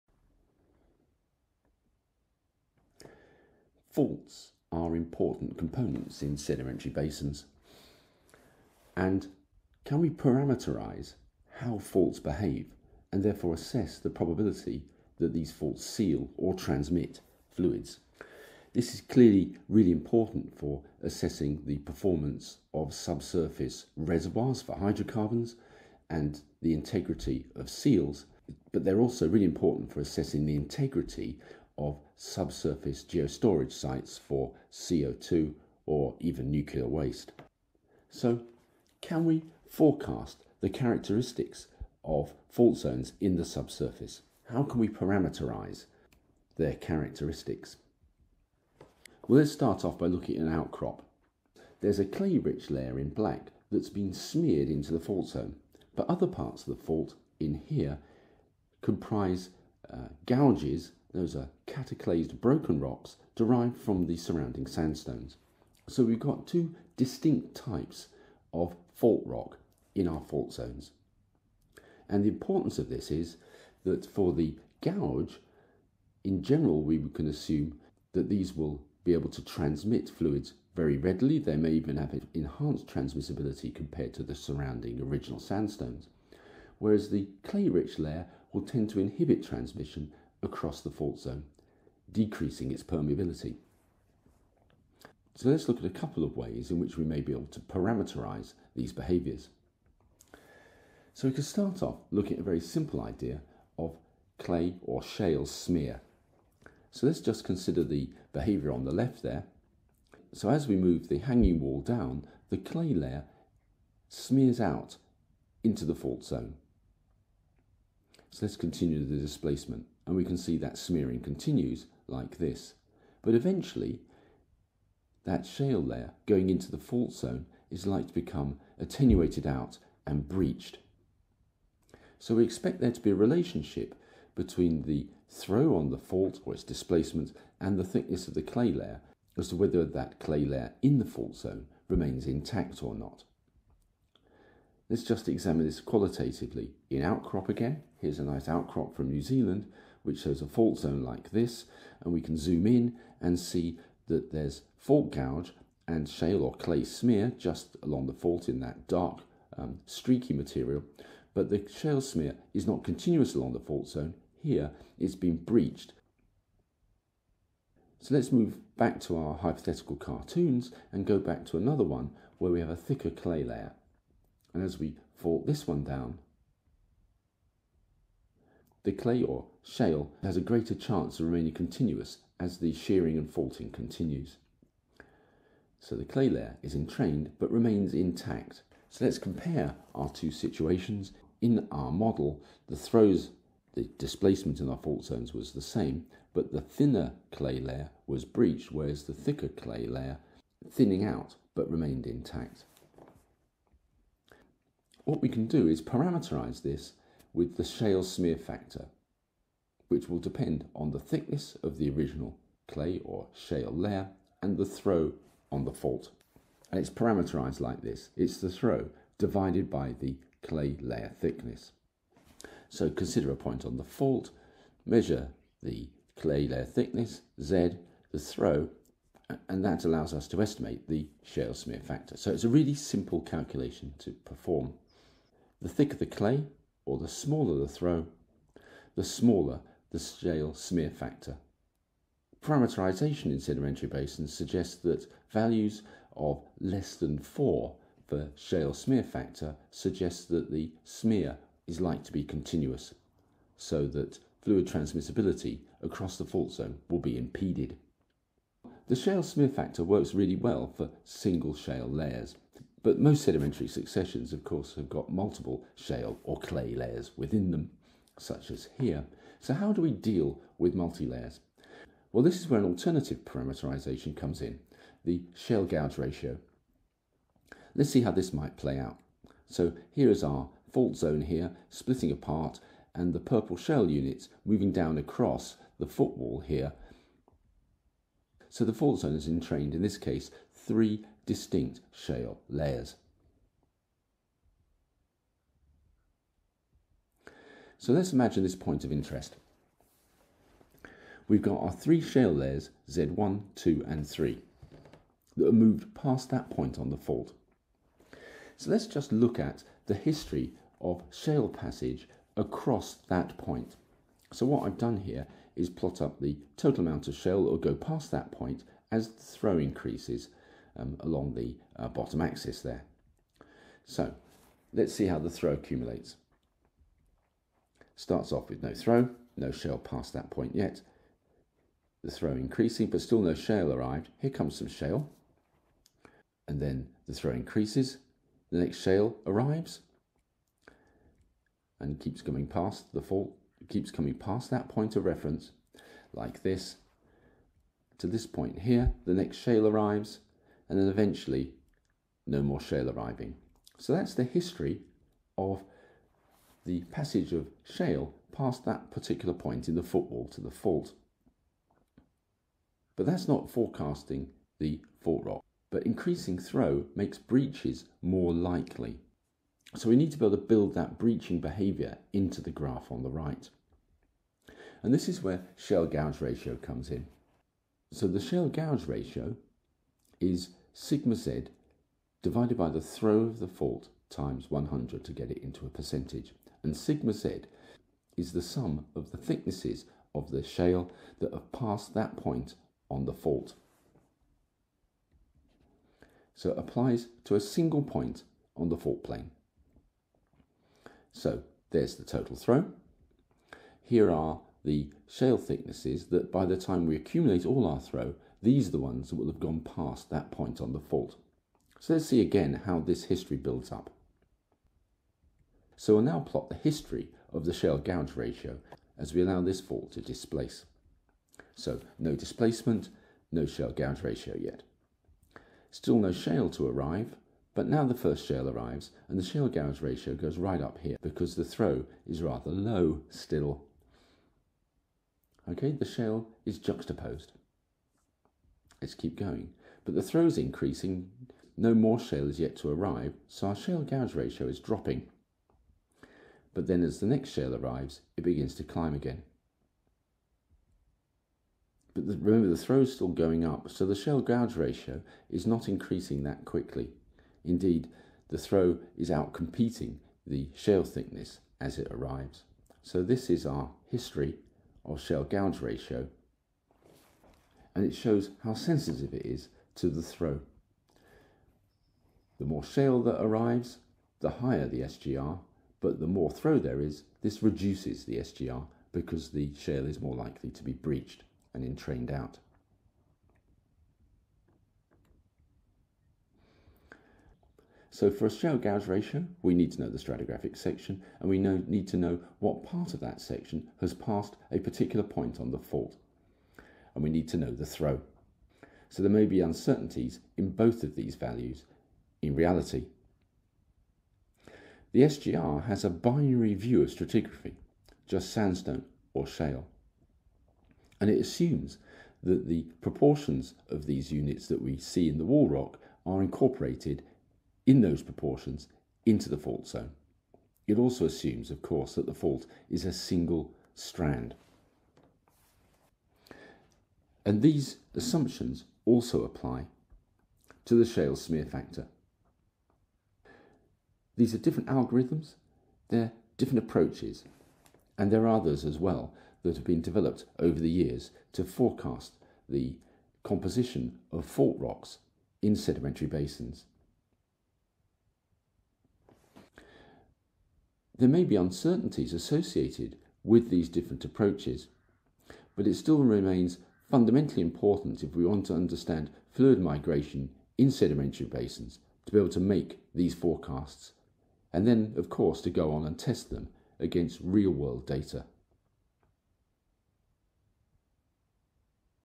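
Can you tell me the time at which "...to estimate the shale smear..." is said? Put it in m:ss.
3:50.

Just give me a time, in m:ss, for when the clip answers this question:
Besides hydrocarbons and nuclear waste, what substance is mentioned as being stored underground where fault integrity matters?
0:34.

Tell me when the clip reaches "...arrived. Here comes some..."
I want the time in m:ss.
5:33.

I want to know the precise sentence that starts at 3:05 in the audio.
So the clay layer is entrained but remains intact.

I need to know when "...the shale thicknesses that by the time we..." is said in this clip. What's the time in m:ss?
6:44.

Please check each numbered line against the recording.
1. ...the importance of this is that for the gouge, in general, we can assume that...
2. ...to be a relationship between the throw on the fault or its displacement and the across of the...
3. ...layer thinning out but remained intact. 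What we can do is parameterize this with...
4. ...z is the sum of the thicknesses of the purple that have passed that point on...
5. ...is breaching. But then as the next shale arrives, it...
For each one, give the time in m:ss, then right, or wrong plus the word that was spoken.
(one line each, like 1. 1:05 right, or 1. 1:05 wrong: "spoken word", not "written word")
1. 1:12 right
2. 2:12 wrong: "thickness", not "across"
3. 3:19 right
4. 6:27 wrong: "shale", not "purple"
5. 7:24 wrong: "dropping", not "breaching".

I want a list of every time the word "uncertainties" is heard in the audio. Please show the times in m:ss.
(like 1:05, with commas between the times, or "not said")
8:19, 9:11.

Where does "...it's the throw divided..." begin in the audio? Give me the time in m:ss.
3:38.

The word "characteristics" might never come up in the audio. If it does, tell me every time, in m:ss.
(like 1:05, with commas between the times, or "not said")
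0:40, 0:46.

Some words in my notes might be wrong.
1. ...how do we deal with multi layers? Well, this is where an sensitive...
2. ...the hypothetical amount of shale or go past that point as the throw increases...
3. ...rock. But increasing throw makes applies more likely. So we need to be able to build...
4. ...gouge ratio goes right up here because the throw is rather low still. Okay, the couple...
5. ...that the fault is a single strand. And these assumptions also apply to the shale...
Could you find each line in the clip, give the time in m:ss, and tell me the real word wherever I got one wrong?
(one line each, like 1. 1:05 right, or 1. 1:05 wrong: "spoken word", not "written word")
1. 4:29 wrong: "alternative", not "sensitive"
2. 5:16 wrong: "total", not "hypothetical"
3. 6:05 wrong: "breaches", not "applies"
4. 7:09 wrong: "shale", not "couple"
5. 8:41 right.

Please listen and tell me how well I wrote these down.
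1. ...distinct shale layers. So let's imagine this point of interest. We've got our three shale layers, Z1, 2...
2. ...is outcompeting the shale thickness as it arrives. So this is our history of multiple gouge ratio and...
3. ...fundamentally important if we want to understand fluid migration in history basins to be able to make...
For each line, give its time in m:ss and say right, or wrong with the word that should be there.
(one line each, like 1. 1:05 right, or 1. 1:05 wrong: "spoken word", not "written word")
1. 4:51 right
2. 7:38 wrong: "shale", not "multiple"
3. 9:16 wrong: "sedimentary", not "history".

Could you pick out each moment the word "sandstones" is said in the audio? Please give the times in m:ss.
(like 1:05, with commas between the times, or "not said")
1:04, 1:25, 8:28.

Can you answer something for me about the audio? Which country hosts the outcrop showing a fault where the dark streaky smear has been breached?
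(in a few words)
New Zealand.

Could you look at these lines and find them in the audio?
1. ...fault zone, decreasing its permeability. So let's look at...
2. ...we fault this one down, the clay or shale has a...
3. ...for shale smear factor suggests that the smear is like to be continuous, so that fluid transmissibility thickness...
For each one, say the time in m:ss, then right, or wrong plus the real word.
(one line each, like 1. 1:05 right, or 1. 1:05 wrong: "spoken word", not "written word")
1. 1:30 right
2. 2:54 right
3. 4:08 wrong: "across", not "thickness".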